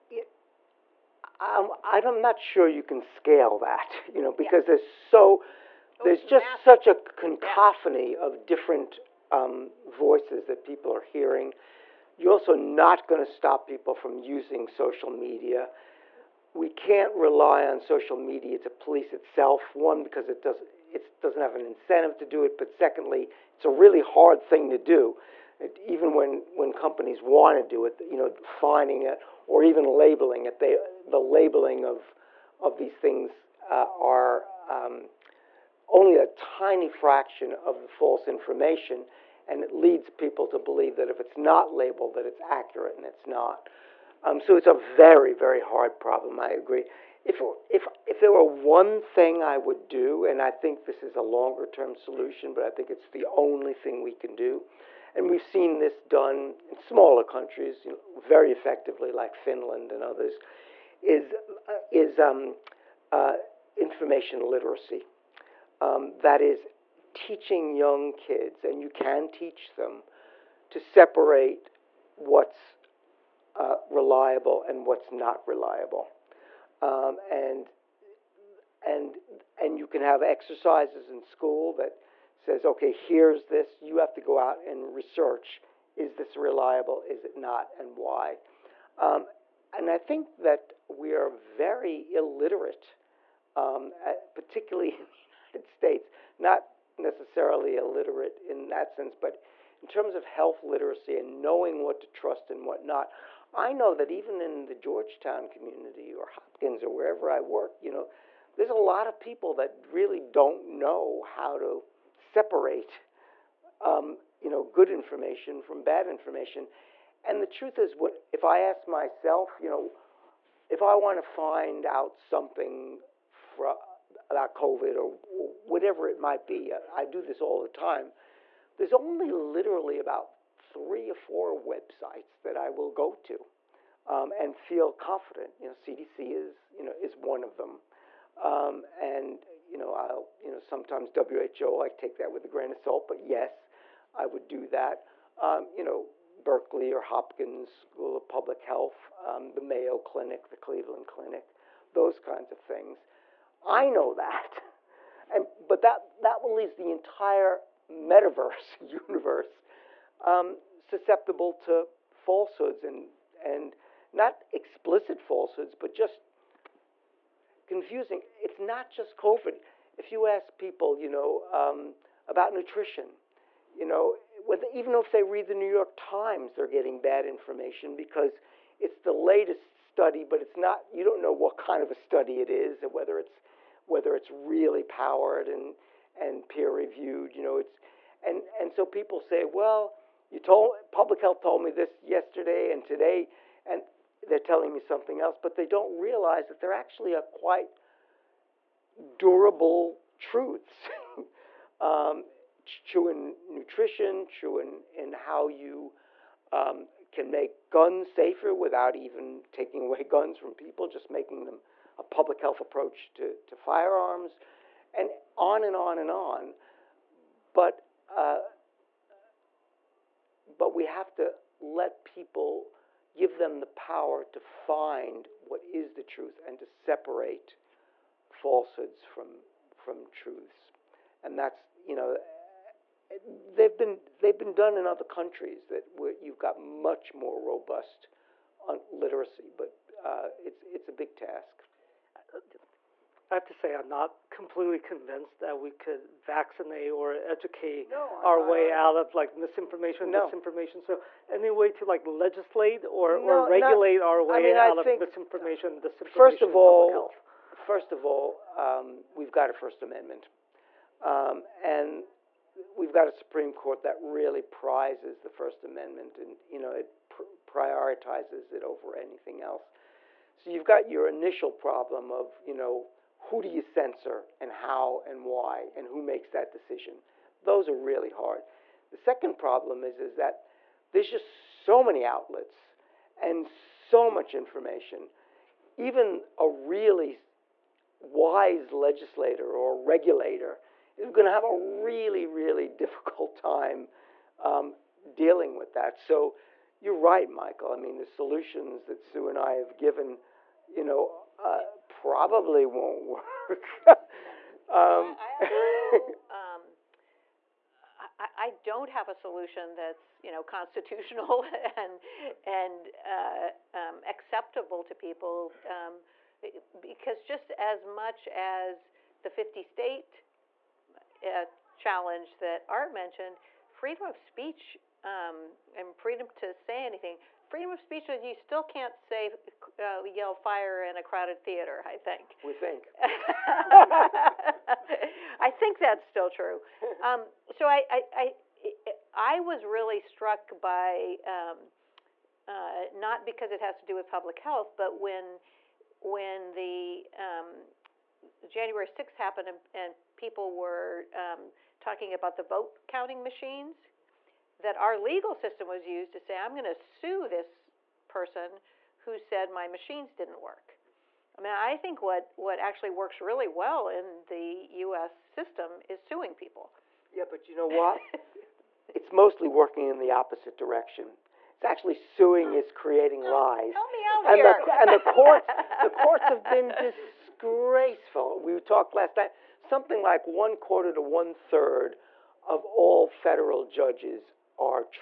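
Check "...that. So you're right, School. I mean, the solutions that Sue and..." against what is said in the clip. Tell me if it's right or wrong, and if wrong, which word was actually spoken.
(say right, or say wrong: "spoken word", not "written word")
wrong: "Michael", not "School".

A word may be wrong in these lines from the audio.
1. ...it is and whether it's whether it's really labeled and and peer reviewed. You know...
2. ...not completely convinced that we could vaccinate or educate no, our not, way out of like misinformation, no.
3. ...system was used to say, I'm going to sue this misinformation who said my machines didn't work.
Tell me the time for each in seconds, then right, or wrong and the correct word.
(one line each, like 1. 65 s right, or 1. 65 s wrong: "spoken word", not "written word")
1. 182 s wrong: "powered", not "labeled"
2. 243 s right
3. 355 s wrong: "person", not "misinformation".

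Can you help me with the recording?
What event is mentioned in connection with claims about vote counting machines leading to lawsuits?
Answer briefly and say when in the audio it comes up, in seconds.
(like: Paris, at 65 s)
January 6th, at 348 s.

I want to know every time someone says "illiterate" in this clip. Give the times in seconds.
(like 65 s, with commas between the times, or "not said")
92 s, 97 s.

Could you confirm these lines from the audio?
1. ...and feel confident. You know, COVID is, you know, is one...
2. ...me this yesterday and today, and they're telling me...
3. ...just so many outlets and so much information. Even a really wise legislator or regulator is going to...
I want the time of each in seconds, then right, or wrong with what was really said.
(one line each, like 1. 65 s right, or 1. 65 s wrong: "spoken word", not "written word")
1. 134 s wrong: "CDC", not "COVID"
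2. 191 s right
3. 281 s right.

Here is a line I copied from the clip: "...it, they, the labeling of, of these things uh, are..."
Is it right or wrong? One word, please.
right.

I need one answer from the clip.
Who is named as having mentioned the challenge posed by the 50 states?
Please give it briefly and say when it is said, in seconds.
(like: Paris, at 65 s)
Art, at 322 s.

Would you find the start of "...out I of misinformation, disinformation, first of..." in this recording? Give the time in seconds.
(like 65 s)
254 s.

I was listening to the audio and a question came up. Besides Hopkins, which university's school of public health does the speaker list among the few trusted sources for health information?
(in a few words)
Berkeley.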